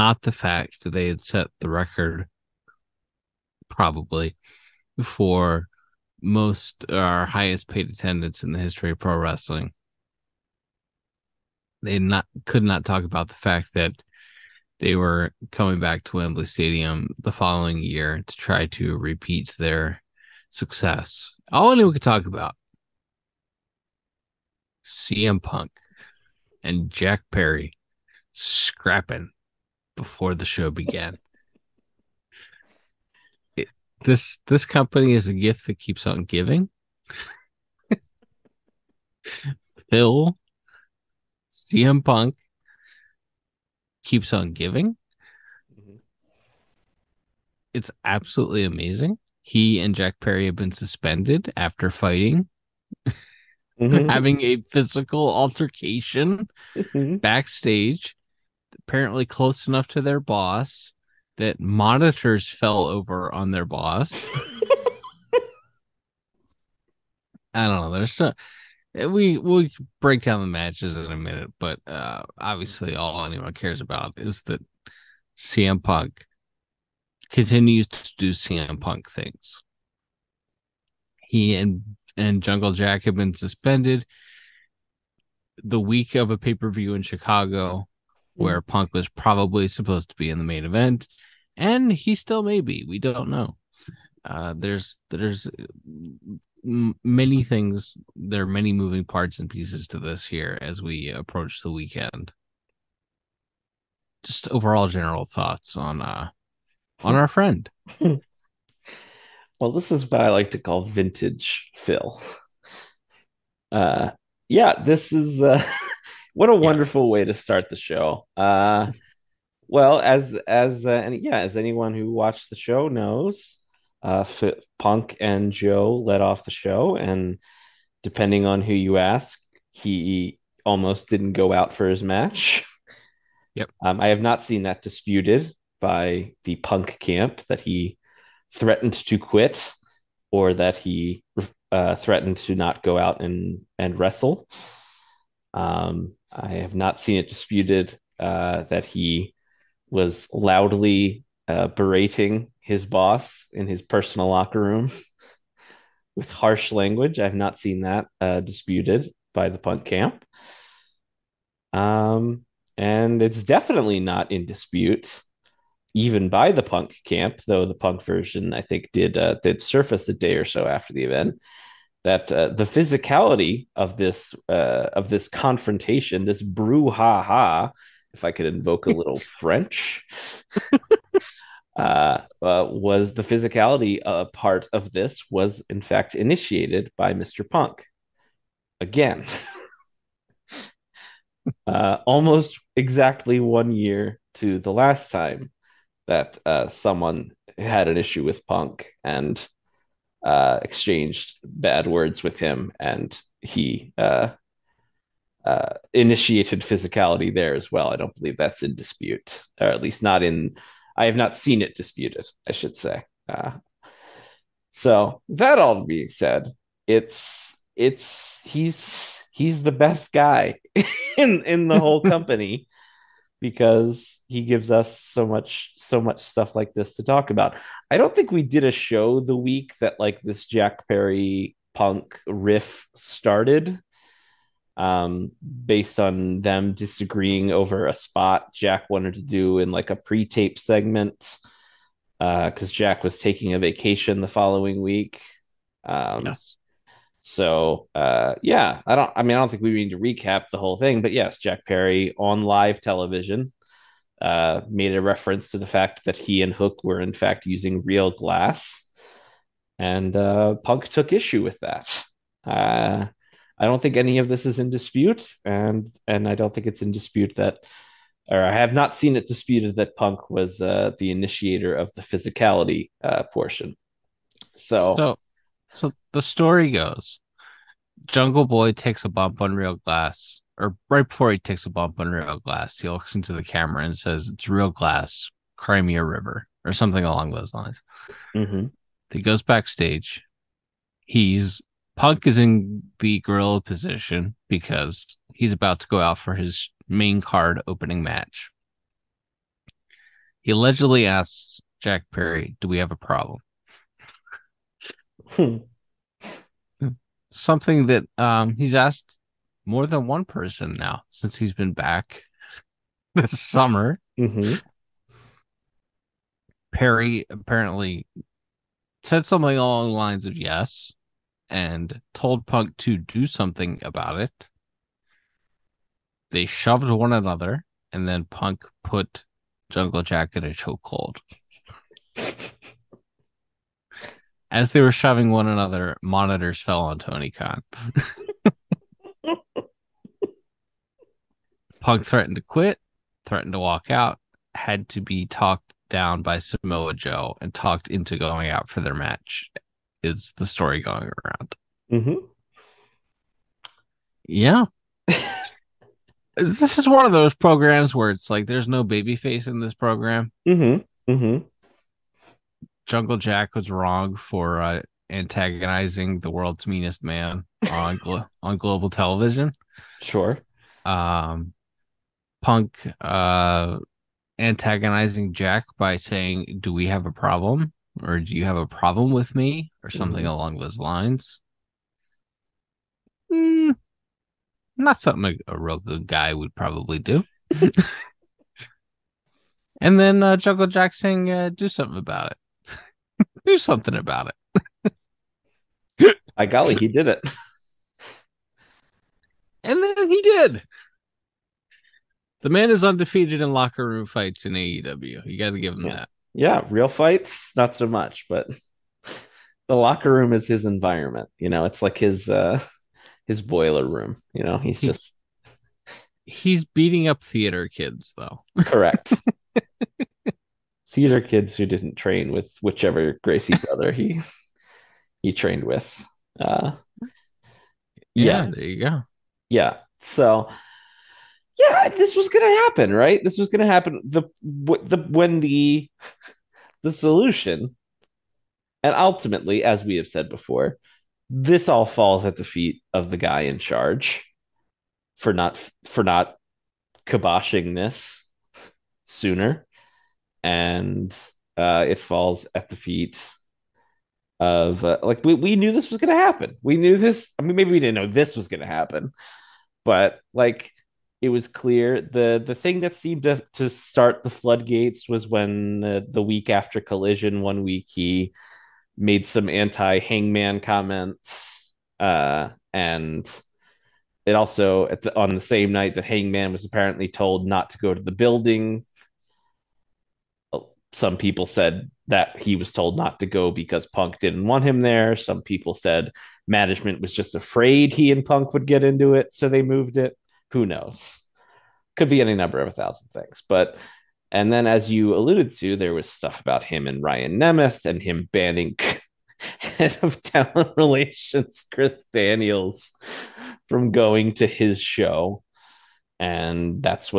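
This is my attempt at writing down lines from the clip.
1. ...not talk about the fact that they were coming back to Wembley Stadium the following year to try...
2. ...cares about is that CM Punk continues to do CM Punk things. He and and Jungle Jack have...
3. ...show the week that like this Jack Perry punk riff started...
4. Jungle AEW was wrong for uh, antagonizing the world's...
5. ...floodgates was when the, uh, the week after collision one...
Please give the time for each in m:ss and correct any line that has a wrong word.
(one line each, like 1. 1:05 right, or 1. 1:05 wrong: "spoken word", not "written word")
1. 0:12 right
2. 1:13 right
3. 3:48 right
4. 6:02 wrong: "Jack", not "AEW"
5. 7:44 right.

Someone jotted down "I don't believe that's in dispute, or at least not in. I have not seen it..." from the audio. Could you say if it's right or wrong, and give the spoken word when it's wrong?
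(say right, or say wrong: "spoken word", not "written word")
right.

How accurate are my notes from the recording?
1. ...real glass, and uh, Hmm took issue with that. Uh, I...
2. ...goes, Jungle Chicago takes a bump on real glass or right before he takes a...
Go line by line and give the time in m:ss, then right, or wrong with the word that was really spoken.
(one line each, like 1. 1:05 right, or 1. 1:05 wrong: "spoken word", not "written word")
1. 4:17 wrong: "Punk", not "Hmm"
2. 4:36 wrong: "Boy", not "Chicago".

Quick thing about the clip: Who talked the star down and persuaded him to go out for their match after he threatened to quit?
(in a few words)
Samoa Joe.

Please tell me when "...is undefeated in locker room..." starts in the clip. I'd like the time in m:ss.
6:42.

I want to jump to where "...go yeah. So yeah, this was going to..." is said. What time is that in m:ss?
7:08.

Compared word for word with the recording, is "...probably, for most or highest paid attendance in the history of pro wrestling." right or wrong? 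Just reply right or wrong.
right.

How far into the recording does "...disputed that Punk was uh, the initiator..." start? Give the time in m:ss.
4:29.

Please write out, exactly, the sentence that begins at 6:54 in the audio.
You know, he's just he's beating up theater kids though.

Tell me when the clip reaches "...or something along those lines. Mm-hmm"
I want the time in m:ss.
4:46.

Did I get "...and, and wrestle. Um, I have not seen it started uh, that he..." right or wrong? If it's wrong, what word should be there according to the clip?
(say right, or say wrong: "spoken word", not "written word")
wrong: "disputed", not "started".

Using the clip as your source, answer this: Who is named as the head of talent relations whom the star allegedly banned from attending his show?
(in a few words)
Chris Daniels.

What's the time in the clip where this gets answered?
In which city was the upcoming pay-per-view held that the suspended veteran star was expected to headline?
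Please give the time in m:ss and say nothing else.
1:27.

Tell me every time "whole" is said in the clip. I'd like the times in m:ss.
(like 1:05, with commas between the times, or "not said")
3:41, 4:10.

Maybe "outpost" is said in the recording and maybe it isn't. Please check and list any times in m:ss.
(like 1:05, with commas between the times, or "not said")
not said.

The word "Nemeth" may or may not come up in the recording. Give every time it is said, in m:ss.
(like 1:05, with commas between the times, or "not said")
8:17.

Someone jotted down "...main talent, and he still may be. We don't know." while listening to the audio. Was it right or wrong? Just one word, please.
wrong.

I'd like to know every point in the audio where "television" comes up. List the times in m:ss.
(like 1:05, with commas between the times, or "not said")
4:12, 6:08.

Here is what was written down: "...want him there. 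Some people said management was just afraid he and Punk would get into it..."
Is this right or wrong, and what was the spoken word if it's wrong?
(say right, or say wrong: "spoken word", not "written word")
right.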